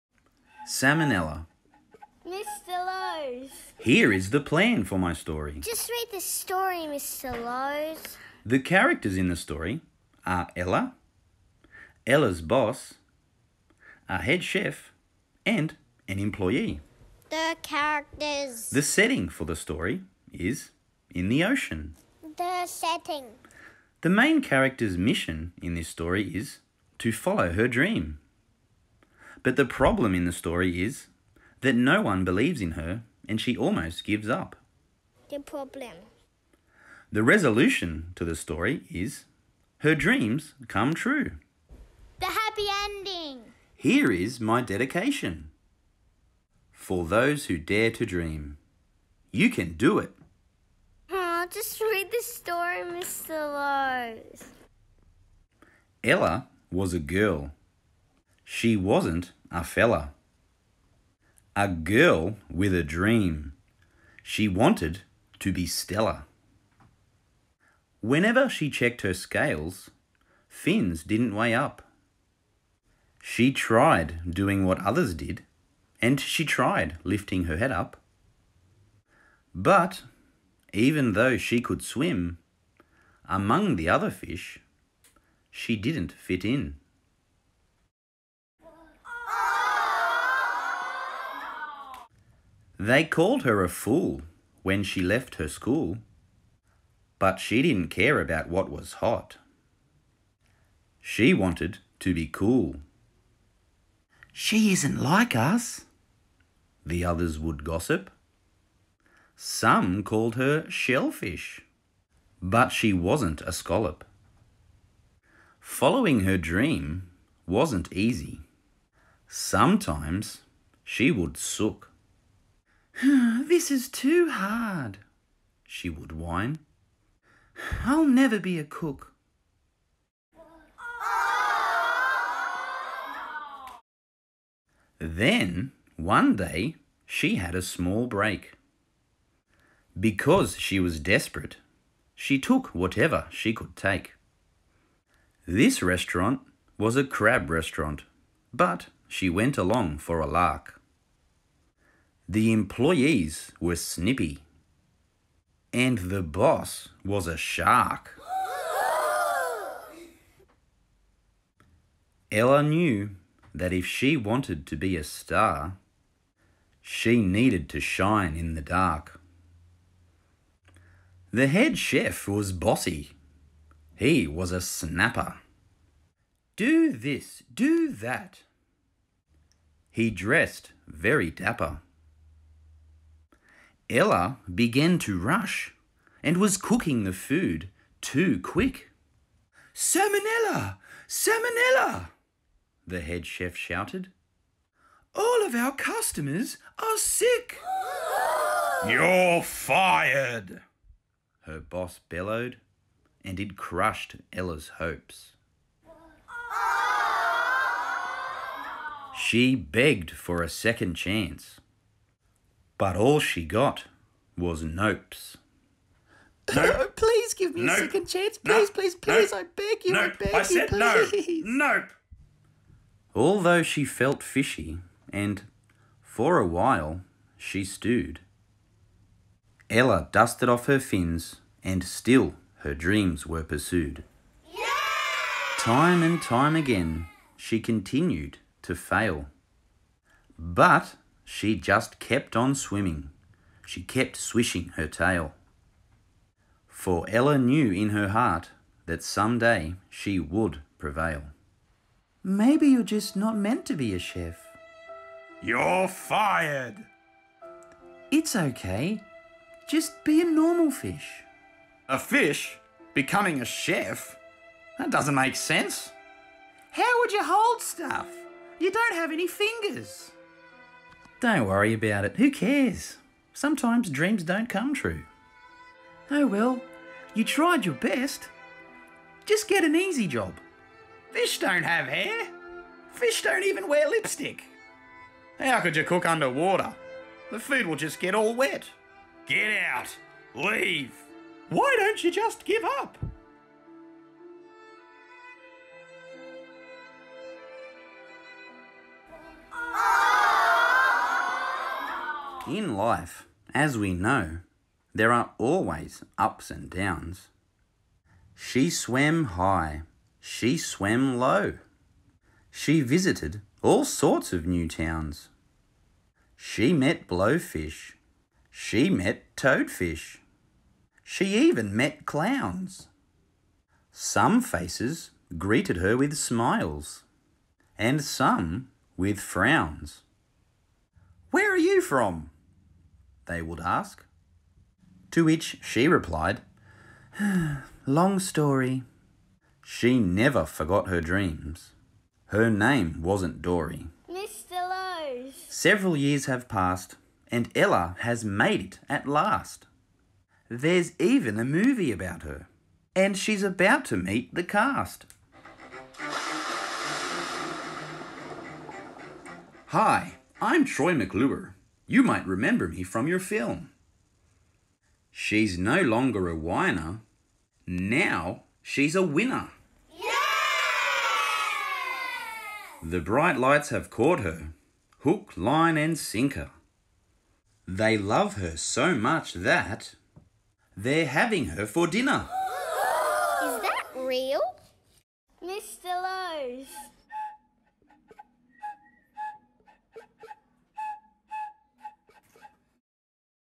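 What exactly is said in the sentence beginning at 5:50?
There's even a movie about her, and she's about to meet the cast.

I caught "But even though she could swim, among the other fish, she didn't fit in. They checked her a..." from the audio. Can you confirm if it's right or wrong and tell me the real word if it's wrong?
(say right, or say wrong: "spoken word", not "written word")
wrong: "called", not "checked".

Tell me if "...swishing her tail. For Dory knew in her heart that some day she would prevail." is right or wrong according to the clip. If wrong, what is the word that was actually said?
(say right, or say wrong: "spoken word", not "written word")
wrong: "Ella", not "Dory".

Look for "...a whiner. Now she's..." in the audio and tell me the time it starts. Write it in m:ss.
6:06.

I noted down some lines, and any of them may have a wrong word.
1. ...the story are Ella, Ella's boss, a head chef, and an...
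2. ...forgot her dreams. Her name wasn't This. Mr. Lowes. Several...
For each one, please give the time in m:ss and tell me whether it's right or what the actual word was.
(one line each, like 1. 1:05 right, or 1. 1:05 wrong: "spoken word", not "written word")
1. 0:09 right
2. 5:40 wrong: "Dory", not "This".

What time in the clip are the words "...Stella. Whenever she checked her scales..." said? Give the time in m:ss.
1:05.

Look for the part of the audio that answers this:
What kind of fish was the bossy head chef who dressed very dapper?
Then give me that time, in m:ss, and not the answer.
2:54.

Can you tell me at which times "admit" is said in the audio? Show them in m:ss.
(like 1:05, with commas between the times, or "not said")
not said.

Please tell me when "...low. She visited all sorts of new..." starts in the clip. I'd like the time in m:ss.
5:11.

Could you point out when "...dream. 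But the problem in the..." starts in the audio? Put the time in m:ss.
0:27.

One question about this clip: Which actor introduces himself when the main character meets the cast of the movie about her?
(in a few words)
Troy McClure.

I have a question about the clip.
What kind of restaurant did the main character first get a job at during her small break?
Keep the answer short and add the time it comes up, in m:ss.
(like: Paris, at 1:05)
A crab restaurant, at 2:27.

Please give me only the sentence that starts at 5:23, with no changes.
Some faces greeted her with smiles, and some with frowns.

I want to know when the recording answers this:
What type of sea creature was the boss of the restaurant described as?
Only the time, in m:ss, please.
2:37.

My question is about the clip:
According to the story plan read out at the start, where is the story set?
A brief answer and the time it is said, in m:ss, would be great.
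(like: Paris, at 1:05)
In the ocean, at 0:21.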